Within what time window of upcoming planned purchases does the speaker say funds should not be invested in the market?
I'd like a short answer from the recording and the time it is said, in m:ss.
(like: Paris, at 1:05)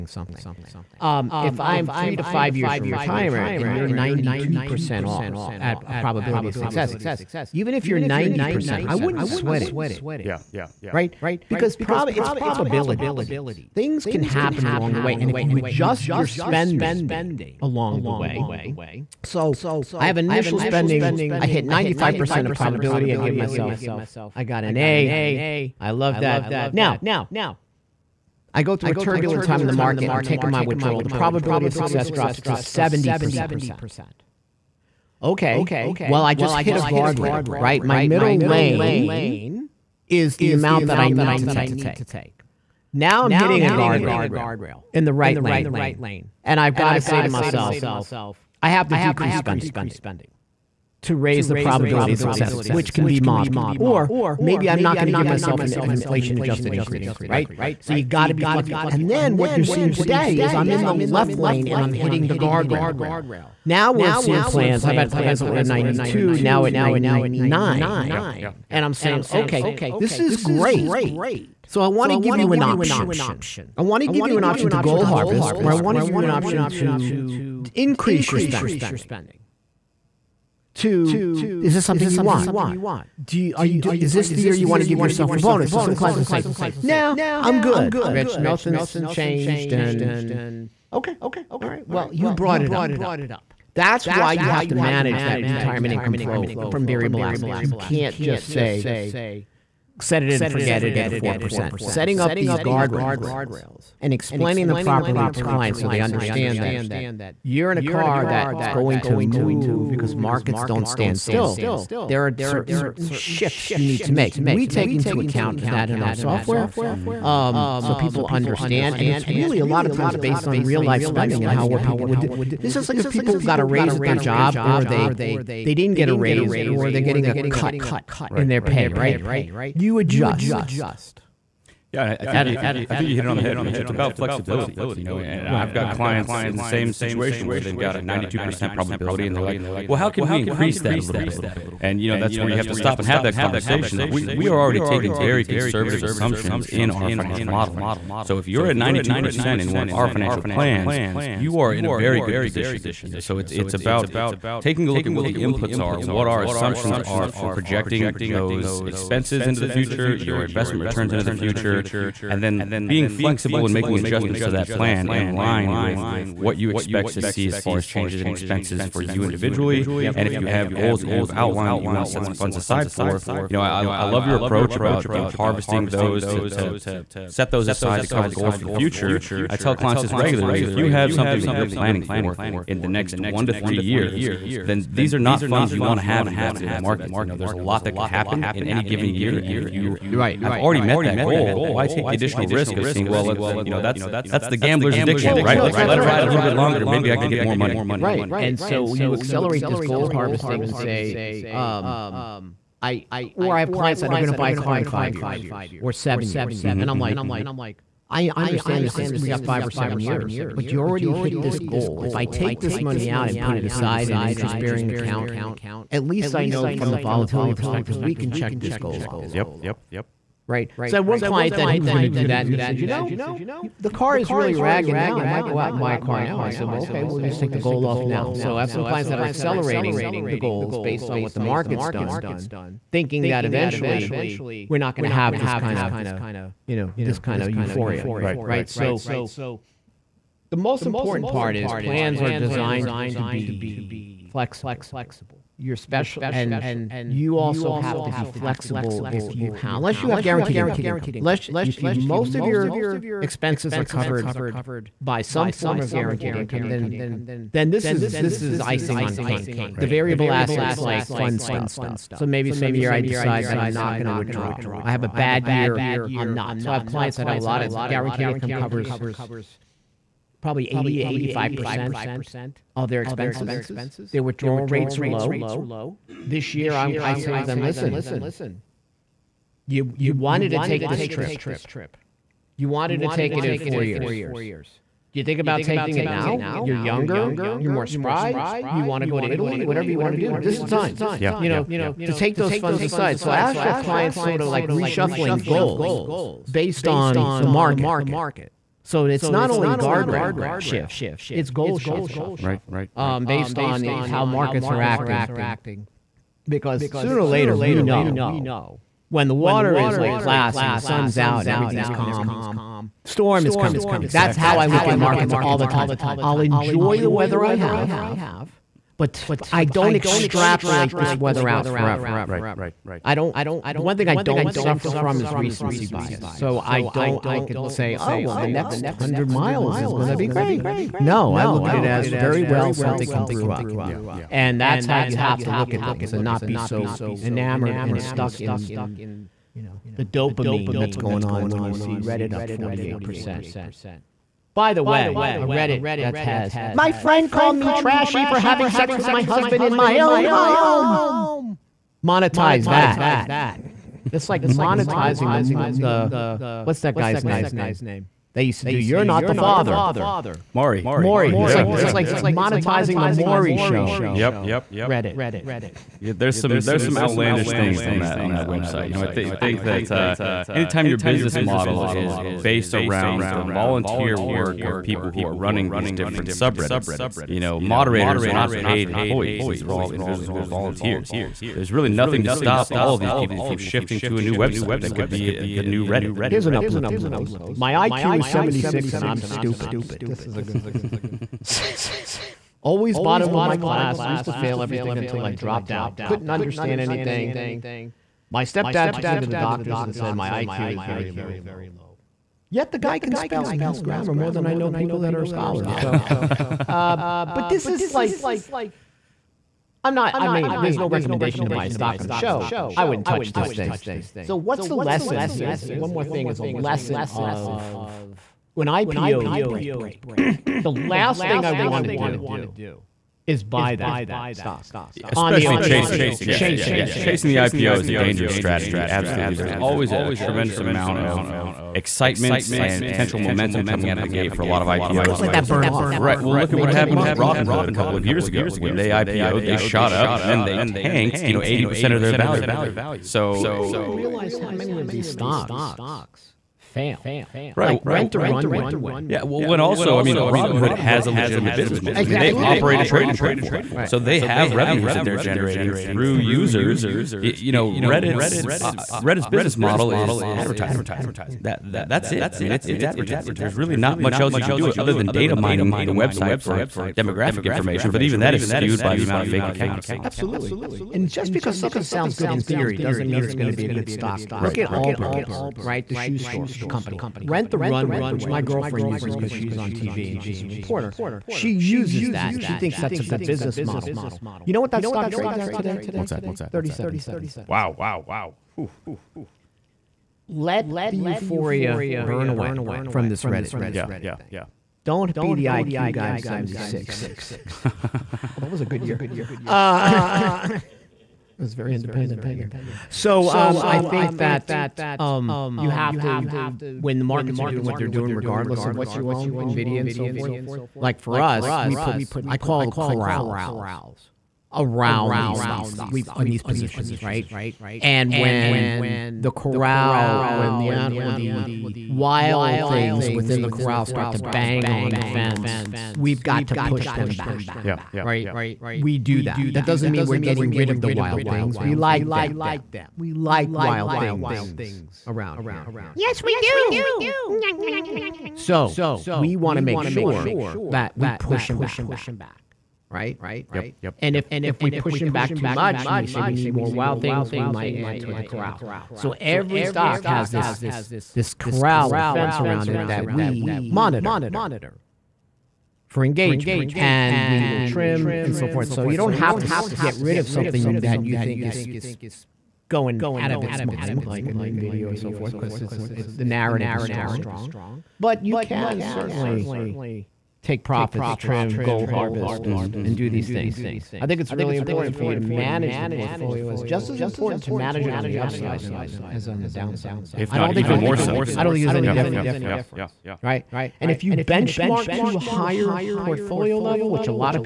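1 to 3 years, at 3:03.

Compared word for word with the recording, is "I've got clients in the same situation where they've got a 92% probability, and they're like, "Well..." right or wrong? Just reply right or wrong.
right.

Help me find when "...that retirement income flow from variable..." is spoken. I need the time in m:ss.
1:35.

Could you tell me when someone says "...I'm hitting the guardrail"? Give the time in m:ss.
1:01.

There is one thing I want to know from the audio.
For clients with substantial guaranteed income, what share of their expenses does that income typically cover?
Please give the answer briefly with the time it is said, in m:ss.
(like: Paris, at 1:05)
80 to 85%, at 4:30.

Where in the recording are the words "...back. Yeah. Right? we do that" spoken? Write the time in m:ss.
8:47.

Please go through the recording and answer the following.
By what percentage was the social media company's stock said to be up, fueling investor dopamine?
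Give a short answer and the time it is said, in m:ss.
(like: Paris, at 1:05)
48%, at 5:42.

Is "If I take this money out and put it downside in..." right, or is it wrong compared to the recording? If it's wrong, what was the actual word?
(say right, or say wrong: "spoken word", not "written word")
wrong: "aside", not "downside".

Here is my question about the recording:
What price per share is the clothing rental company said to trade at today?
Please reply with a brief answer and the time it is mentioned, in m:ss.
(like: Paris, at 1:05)
37 cents, at 8:06.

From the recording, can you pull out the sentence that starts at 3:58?
So the most important part is plans are designed to be flexible.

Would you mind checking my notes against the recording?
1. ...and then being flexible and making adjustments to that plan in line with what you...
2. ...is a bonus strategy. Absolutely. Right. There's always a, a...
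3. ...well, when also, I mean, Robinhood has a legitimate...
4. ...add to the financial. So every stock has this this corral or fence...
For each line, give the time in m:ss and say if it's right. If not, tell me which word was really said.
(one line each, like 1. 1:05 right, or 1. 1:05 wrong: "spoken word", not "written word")
1. 2:42 right
2. 7:07 wrong: "dangerous", not "bonus"
3. 7:29 right
4. 9:07 wrong: "corral", not "financial".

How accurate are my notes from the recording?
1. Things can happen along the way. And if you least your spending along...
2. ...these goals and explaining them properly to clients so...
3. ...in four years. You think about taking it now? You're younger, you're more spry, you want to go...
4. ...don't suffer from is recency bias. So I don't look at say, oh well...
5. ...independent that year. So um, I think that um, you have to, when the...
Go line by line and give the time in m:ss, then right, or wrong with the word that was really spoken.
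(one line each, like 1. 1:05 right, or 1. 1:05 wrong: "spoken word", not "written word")
1. 0:13 wrong: "adjust", not "least"
2. 1:42 wrong: "guardrails", not "goals"
3. 4:43 right
4. 5:24 right
5. 8:21 right.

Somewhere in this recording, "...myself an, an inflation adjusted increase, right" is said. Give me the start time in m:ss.
0:55.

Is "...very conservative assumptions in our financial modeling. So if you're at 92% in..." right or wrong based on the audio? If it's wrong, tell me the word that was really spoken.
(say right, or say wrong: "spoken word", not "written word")
right.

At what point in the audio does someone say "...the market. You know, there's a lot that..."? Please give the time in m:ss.
3:06.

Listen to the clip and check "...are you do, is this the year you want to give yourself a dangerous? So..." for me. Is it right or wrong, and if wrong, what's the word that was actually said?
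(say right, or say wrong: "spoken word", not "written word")
wrong: "bonus", not "dangerous".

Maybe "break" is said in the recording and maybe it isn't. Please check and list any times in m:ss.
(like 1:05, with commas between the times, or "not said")
6:59.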